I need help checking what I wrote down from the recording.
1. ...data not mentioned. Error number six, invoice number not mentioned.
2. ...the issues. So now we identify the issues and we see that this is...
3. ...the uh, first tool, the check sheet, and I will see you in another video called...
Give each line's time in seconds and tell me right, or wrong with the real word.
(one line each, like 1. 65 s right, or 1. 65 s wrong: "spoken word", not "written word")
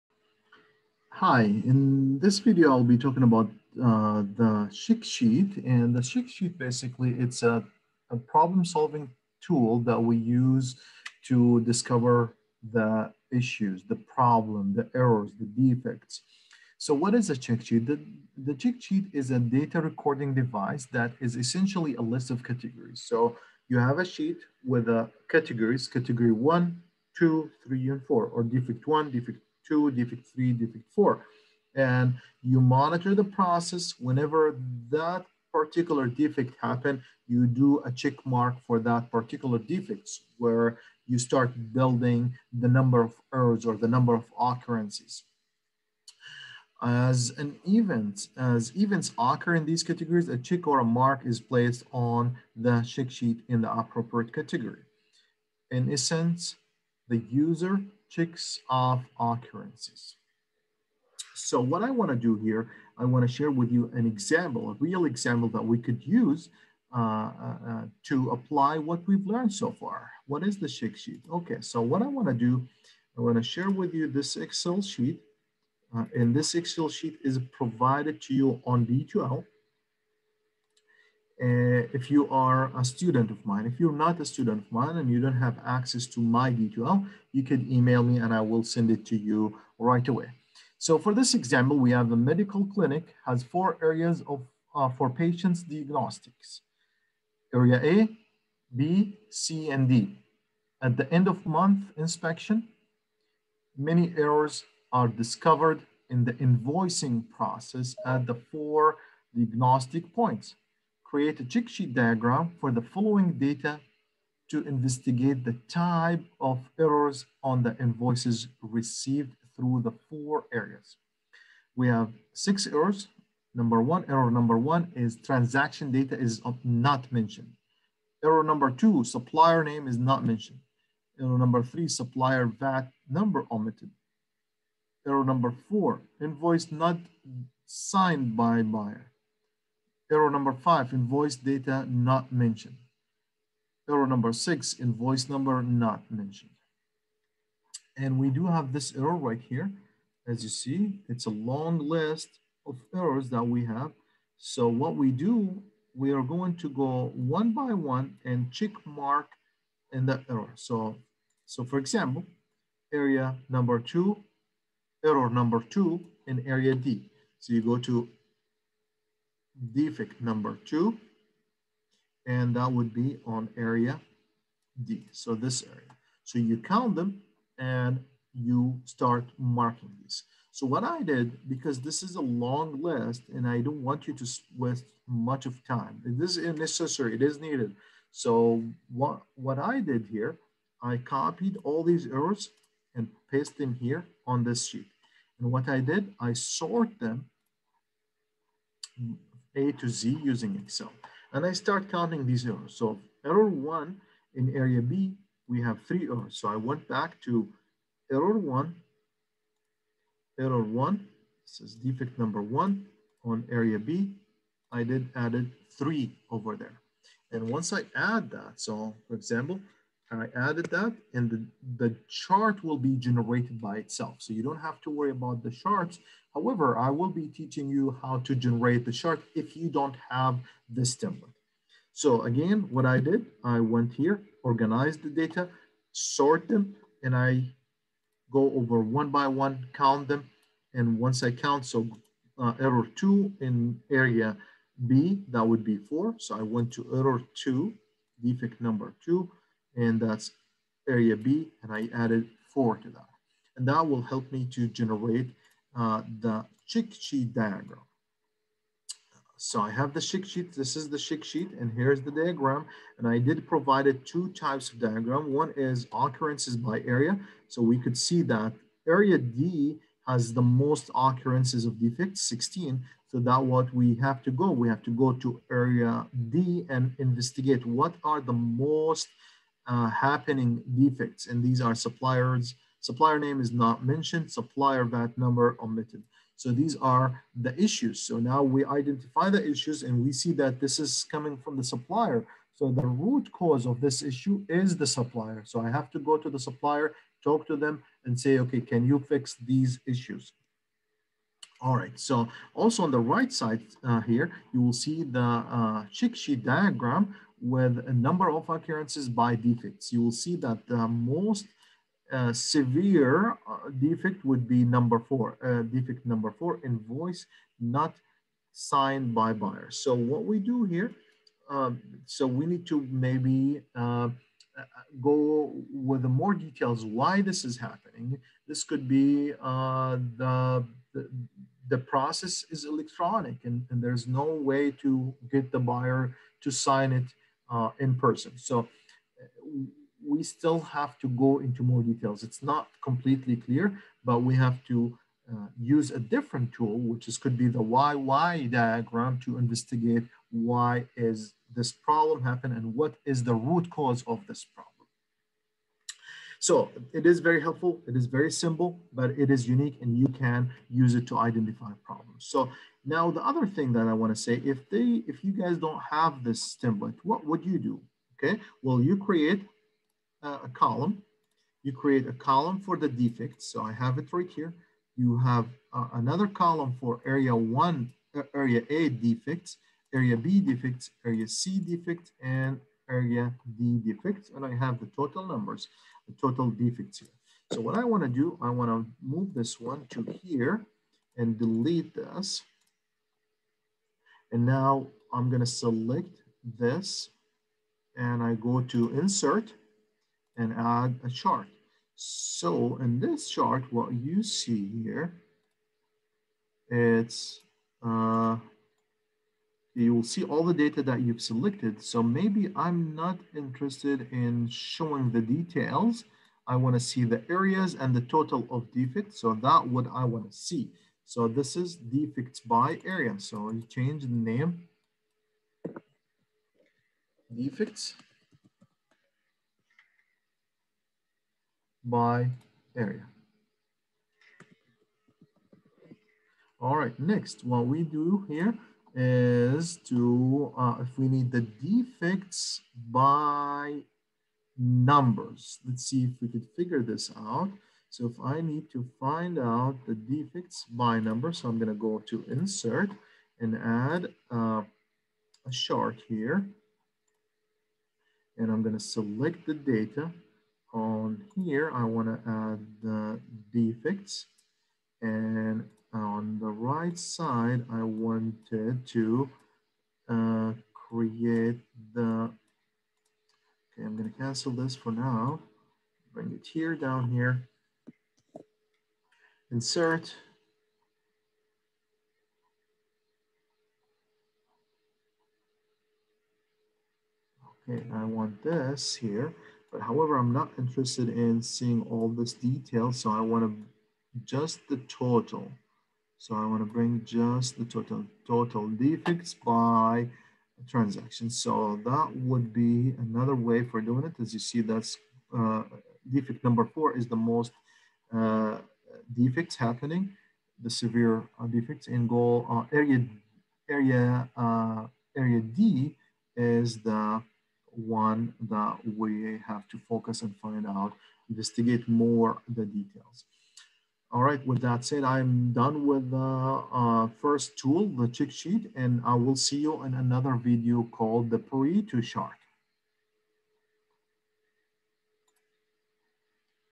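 1. 141 s right
2. 287 s right
3. 526 s right.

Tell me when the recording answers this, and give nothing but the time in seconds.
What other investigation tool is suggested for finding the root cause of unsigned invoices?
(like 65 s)
347 s.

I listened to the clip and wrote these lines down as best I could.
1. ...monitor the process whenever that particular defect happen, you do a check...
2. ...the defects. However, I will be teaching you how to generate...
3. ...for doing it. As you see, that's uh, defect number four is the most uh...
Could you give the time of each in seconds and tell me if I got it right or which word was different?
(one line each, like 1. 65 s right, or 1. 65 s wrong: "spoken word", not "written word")
1. 32 s right
2. 225 s wrong: "charts", not "defects"
3. 503 s right.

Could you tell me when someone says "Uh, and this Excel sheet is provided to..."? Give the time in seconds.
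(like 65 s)
75 s.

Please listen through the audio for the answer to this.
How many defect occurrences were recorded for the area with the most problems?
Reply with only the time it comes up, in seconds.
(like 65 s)
272 s.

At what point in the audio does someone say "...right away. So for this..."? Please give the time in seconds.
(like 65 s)
89 s.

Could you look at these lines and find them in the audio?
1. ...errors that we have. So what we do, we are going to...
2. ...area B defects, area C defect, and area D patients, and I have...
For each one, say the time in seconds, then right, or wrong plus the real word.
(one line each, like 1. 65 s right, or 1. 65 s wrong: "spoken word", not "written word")
1. 152 s right
2. 379 s wrong: "defects", not "patients".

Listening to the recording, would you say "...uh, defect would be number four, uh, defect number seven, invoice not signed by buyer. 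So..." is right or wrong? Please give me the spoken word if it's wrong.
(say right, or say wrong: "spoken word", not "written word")
wrong: "four", not "seven".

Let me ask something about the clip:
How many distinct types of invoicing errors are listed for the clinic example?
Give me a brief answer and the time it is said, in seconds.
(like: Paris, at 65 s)
6, at 122 s.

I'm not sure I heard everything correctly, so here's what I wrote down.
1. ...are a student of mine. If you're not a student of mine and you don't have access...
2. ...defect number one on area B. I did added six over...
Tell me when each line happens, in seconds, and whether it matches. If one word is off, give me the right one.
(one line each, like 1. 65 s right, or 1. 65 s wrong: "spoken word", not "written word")
1. 82 s right
2. 211 s wrong: "three", not "six".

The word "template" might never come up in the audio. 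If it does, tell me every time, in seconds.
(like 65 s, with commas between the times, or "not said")
230 s, 366 s.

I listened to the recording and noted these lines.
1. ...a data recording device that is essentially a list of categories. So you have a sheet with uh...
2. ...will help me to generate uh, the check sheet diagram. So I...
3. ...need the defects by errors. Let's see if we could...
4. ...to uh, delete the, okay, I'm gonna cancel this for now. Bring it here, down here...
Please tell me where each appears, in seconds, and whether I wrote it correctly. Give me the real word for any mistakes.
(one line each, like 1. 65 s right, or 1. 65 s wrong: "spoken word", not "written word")
1. 19 s right
2. 253 s right
3. 441 s wrong: "numbers", not "errors"
4. 468 s wrong: "create", not "delete".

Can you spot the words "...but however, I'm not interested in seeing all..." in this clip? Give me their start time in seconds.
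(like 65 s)
489 s.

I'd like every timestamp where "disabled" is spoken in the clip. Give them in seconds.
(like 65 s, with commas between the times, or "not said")
not said.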